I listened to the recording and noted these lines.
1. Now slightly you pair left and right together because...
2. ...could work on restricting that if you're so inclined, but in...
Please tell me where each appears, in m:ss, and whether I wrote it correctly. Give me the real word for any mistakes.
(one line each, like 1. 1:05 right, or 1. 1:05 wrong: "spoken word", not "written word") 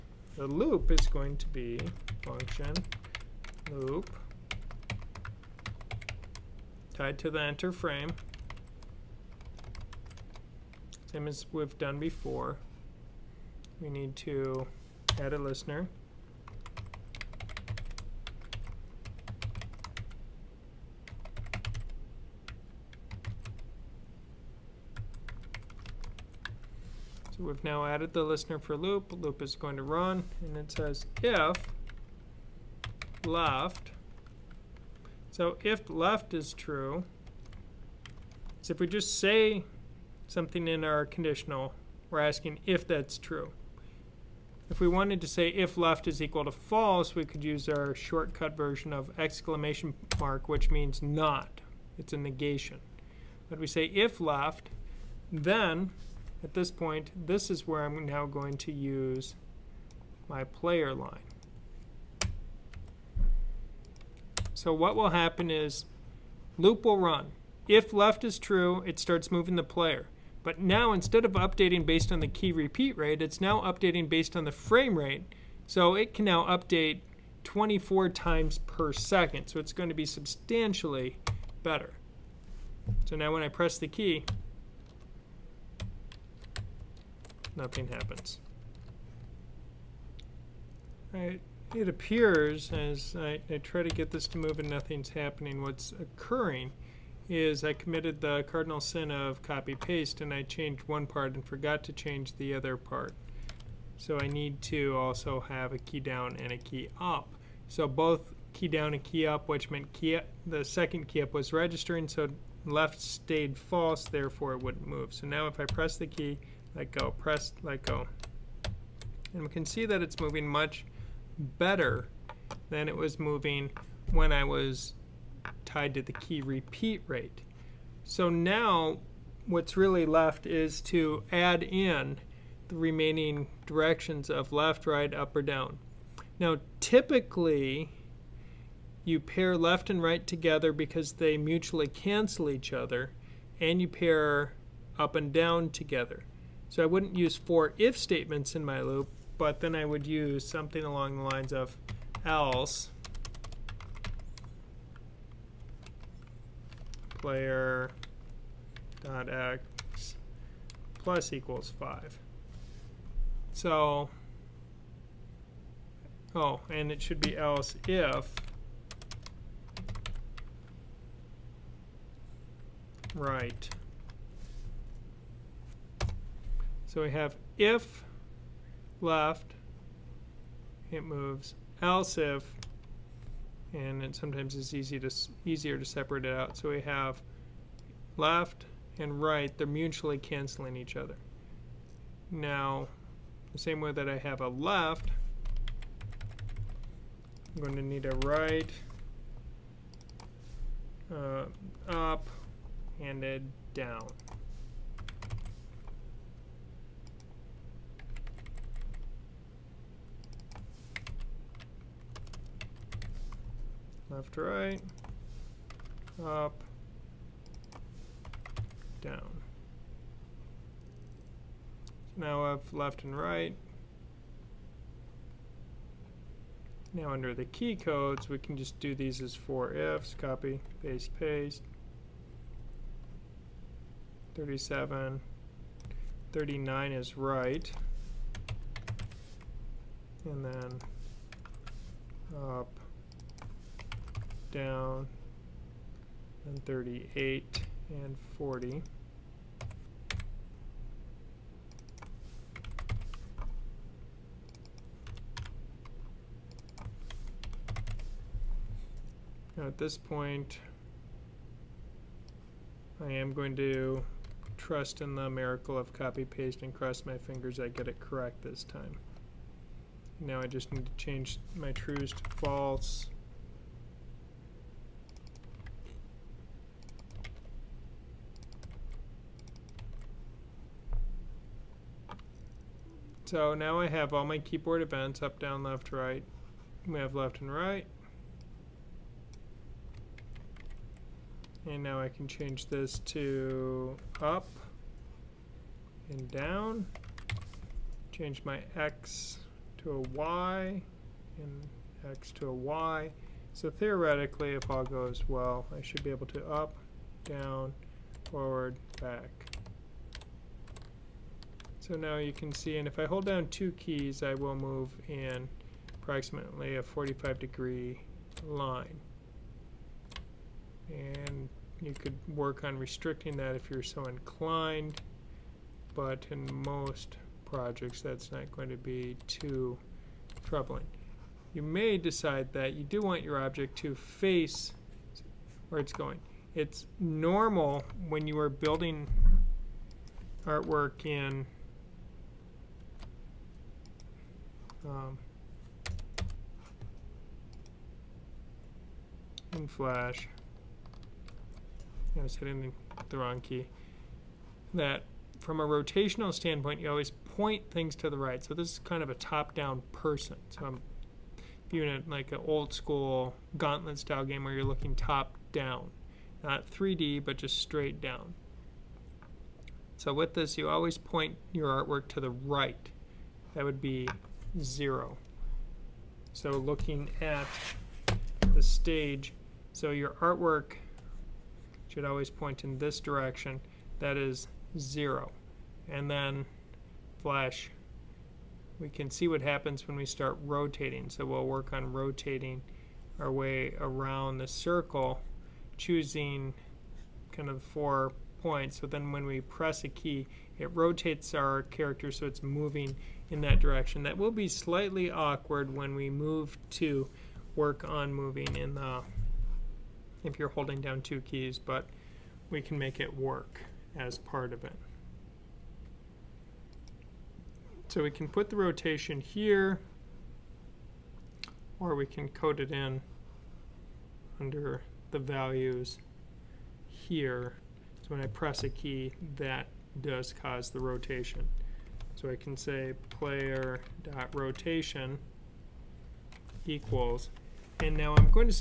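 1. 2:16 wrong: "typically", not "slightly"
2. 5:21 right.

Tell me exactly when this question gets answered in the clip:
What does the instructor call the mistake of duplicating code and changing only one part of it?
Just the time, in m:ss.
1:38.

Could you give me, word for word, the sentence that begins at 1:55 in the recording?
So now if I press the key, let go, press, let go.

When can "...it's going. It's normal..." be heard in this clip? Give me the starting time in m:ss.
5:35.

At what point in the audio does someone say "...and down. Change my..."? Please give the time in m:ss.
4:56.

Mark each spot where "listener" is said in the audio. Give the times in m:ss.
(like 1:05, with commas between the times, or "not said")
0:15, 0:28.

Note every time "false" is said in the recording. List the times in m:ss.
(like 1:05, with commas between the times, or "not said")
0:46, 1:53, 4:32.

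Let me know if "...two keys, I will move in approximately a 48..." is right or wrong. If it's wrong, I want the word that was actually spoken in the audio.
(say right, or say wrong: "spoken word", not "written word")
wrong: "45", not "48".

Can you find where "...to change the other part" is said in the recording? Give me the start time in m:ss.
1:41.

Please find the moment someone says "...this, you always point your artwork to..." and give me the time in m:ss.
6:10.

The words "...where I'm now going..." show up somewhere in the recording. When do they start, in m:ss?
0:57.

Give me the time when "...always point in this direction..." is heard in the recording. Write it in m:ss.
6:22.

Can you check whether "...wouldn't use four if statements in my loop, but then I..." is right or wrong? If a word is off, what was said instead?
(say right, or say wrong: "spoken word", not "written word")
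right.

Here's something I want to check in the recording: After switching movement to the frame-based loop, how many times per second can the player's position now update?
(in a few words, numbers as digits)
24.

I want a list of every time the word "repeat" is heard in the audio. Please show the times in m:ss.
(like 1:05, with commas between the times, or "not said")
1:12, 2:06.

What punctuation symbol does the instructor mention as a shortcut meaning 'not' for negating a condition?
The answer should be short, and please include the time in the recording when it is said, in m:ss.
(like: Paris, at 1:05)
exclamation mark, at 0:49.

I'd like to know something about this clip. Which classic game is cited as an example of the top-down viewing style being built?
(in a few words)
Gauntlet.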